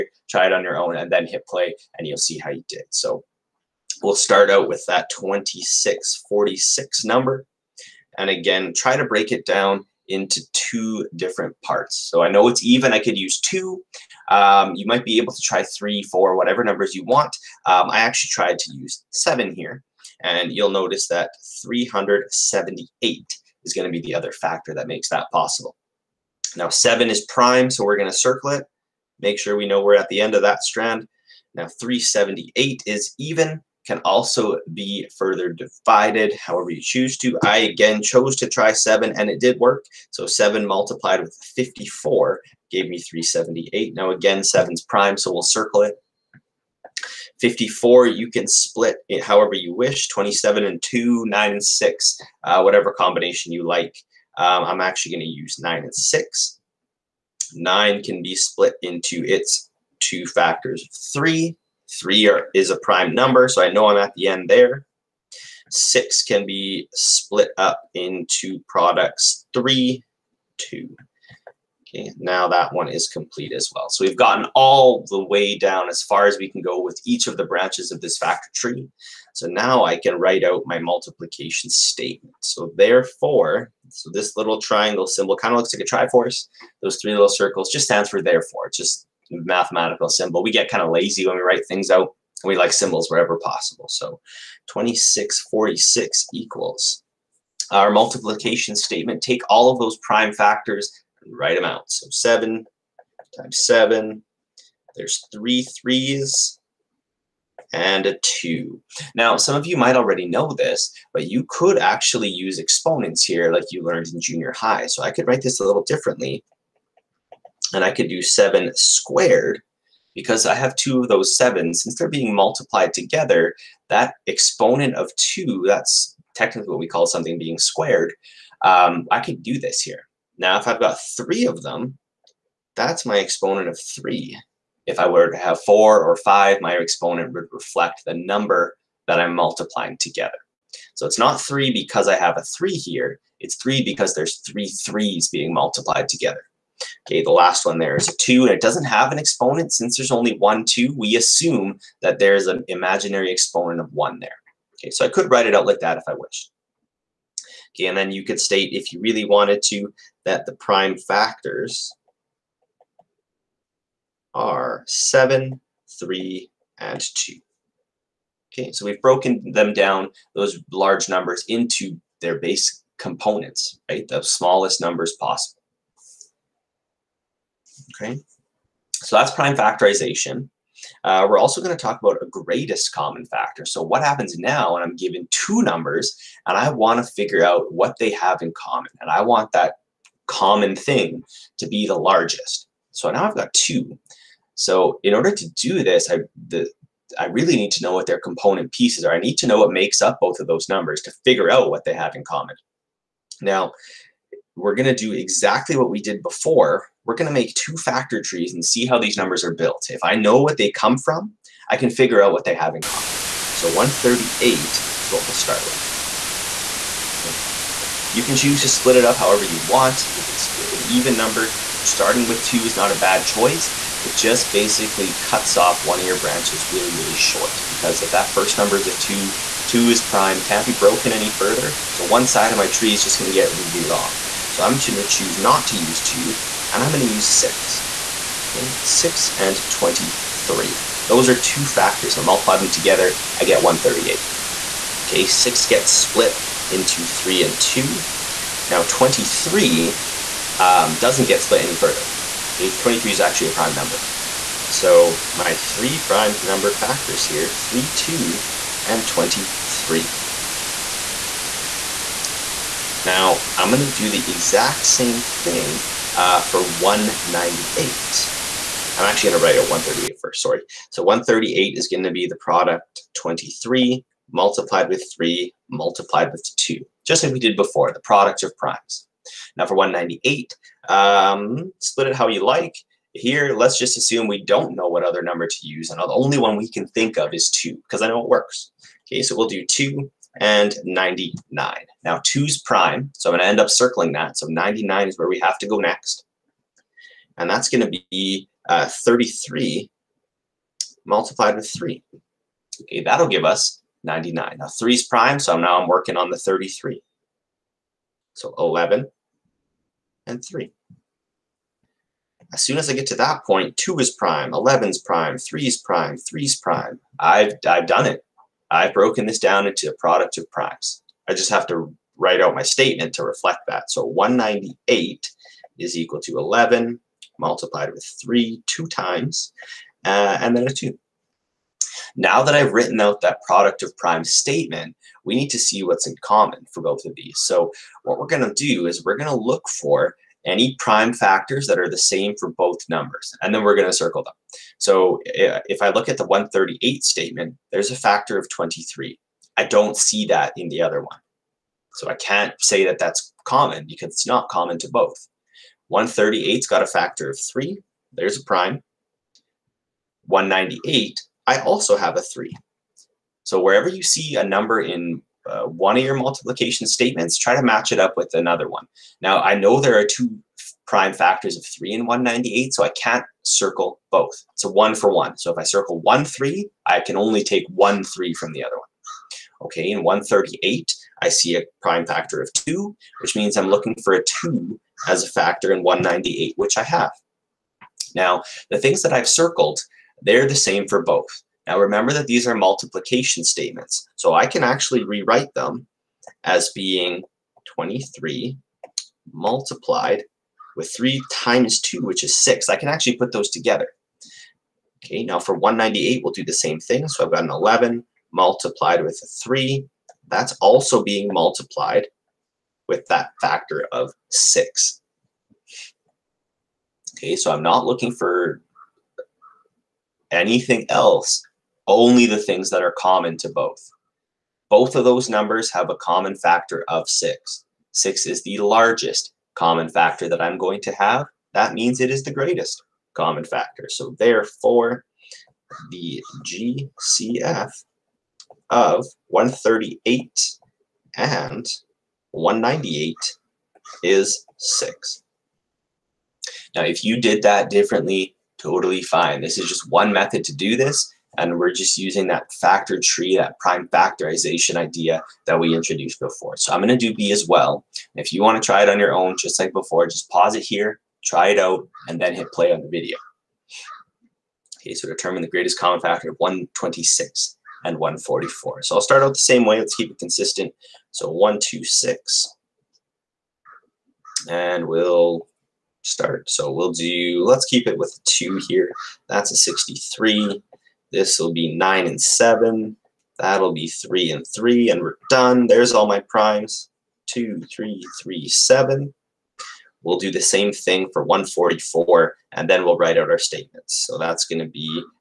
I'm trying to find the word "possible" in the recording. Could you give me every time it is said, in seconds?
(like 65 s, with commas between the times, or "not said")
25 s, 93 s, 175 s.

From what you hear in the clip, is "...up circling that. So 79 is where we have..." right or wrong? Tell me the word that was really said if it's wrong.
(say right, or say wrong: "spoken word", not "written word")
wrong: "99", not "79".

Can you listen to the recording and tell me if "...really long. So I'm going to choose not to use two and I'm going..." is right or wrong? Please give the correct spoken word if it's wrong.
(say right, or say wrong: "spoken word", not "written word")
right.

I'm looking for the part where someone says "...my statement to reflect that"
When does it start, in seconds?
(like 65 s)
322 s.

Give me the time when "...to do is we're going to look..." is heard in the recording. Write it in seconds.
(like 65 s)
338 s.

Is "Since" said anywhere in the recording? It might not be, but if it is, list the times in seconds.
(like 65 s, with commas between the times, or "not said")
121 s, 149 s.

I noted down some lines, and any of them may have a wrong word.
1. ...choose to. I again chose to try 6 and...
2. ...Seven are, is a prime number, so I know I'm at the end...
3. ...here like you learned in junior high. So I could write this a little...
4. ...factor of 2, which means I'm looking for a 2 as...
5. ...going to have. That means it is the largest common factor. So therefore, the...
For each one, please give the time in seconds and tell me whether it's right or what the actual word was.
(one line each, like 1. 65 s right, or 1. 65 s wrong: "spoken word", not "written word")
1. 36 s wrong: "7", not "6"
2. 61 s wrong: "Three", not "Seven"
3. 113 s right
4. 382 s right
5. 430 s wrong: "greatest", not "largest".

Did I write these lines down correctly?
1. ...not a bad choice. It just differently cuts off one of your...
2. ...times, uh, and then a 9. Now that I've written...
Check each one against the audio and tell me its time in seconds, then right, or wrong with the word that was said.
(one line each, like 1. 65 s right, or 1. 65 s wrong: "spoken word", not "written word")
1. 222 s wrong: "basically", not "differently"
2. 328 s wrong: "2", not "9".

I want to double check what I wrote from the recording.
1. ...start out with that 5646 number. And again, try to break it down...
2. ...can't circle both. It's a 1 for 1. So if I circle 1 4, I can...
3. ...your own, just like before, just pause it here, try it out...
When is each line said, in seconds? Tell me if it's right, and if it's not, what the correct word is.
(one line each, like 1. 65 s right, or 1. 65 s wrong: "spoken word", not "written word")
1. 4 s wrong: "2646", not "5646"
2. 372 s wrong: "3", not "4"
3. 458 s right.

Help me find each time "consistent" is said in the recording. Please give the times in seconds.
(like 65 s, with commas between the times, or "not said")
470 s.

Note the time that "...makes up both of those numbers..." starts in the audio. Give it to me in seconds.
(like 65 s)
199 s.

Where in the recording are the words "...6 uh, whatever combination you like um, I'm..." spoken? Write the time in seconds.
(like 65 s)
51 s.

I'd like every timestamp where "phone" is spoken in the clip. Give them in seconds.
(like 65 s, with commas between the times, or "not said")
not said.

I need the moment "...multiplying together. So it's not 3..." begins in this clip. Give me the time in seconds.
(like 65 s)
139 s.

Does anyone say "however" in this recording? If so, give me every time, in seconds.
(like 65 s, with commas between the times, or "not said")
36 s, 49 s, 219 s.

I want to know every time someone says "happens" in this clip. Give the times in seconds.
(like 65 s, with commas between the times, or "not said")
184 s.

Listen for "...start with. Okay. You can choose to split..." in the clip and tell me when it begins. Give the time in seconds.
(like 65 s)
215 s.